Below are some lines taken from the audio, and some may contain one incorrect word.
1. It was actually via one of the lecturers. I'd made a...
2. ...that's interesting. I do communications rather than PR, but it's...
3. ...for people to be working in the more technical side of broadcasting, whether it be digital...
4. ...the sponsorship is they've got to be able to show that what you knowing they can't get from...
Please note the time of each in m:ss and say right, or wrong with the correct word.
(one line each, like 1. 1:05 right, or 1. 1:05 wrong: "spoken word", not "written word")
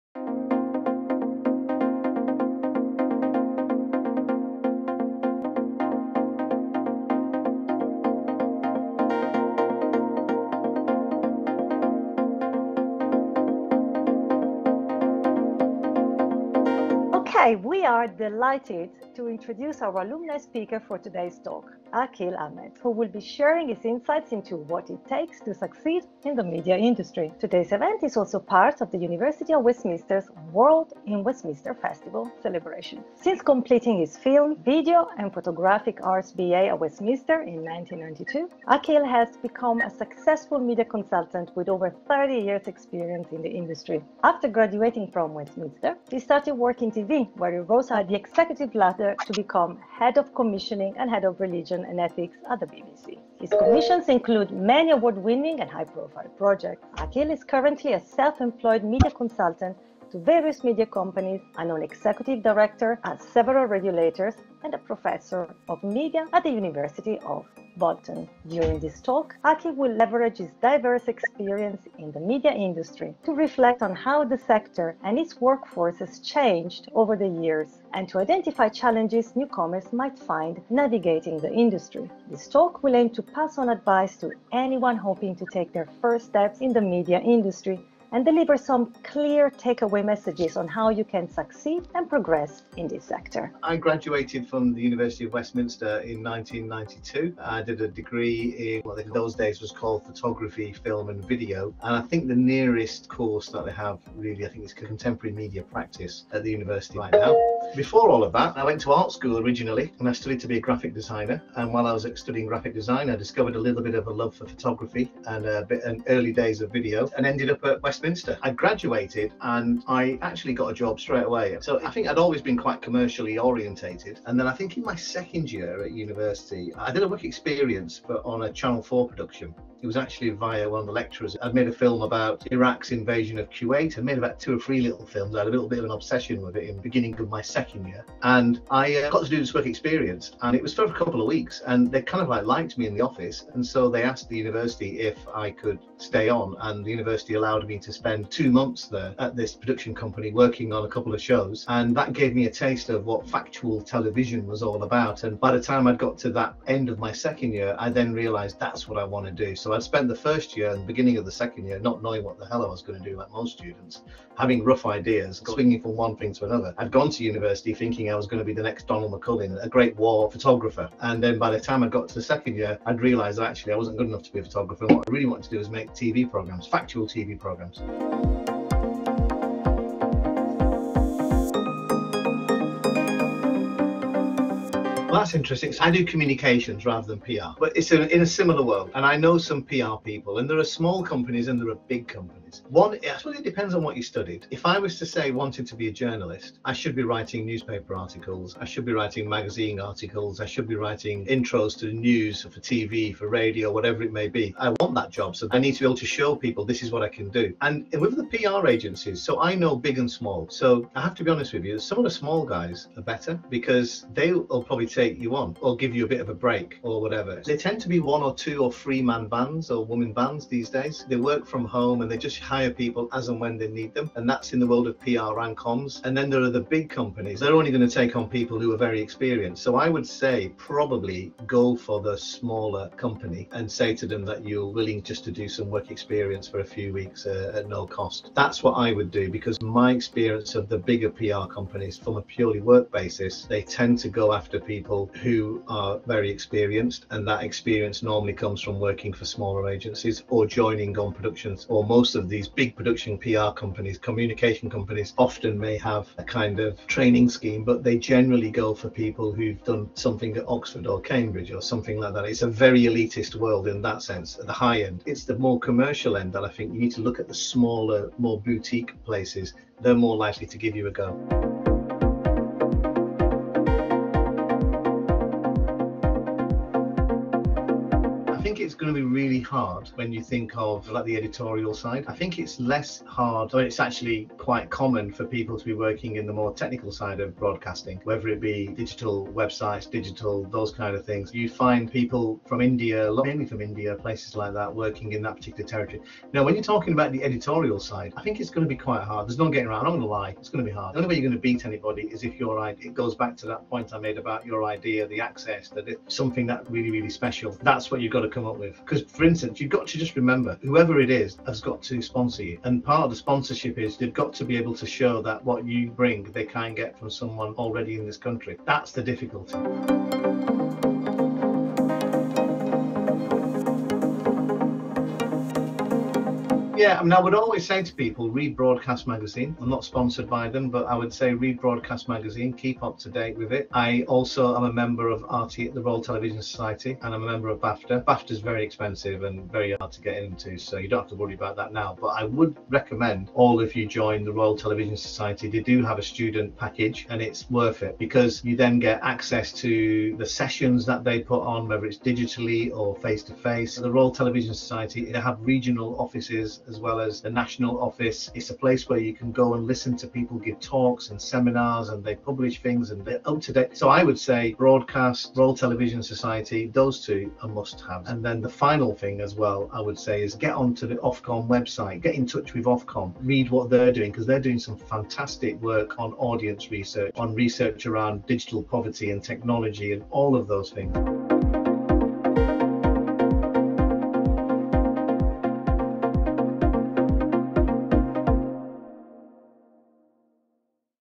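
1. 2:09 right
2. 3:05 right
3. 4:45 right
4. 5:13 wrong: "bring", not "knowing".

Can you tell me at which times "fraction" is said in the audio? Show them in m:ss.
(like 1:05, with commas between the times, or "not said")
not said.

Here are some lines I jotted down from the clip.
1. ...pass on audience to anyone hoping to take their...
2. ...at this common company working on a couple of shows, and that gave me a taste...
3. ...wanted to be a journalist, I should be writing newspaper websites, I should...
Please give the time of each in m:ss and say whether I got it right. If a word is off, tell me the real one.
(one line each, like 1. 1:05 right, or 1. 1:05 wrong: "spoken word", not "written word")
1. 1:23 wrong: "advice", not "audience"
2. 2:29 wrong: "production", not "common"
3. 3:15 wrong: "articles", not "websites".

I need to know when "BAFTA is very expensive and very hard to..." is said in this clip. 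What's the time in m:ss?
5:38.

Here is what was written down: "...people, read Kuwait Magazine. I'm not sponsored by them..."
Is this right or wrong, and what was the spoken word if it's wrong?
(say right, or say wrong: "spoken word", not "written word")
wrong: "Broadcast", not "Kuwait".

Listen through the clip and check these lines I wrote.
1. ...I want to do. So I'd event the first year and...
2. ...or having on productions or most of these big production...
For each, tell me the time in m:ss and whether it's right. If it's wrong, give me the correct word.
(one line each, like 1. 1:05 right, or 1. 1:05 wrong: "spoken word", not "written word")
1. 2:38 wrong: "spent", not "event"
2. 4:10 wrong: "joining", not "having".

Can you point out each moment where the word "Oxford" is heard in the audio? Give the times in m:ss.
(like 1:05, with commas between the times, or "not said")
4:20.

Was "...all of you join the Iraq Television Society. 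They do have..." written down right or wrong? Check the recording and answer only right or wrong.
wrong.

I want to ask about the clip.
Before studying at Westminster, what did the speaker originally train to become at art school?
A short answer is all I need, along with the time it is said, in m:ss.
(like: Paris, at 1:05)
Graphic designer, at 1:50.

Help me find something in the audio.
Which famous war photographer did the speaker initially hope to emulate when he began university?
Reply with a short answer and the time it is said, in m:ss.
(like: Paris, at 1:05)
Donald McCullin, at 2:48.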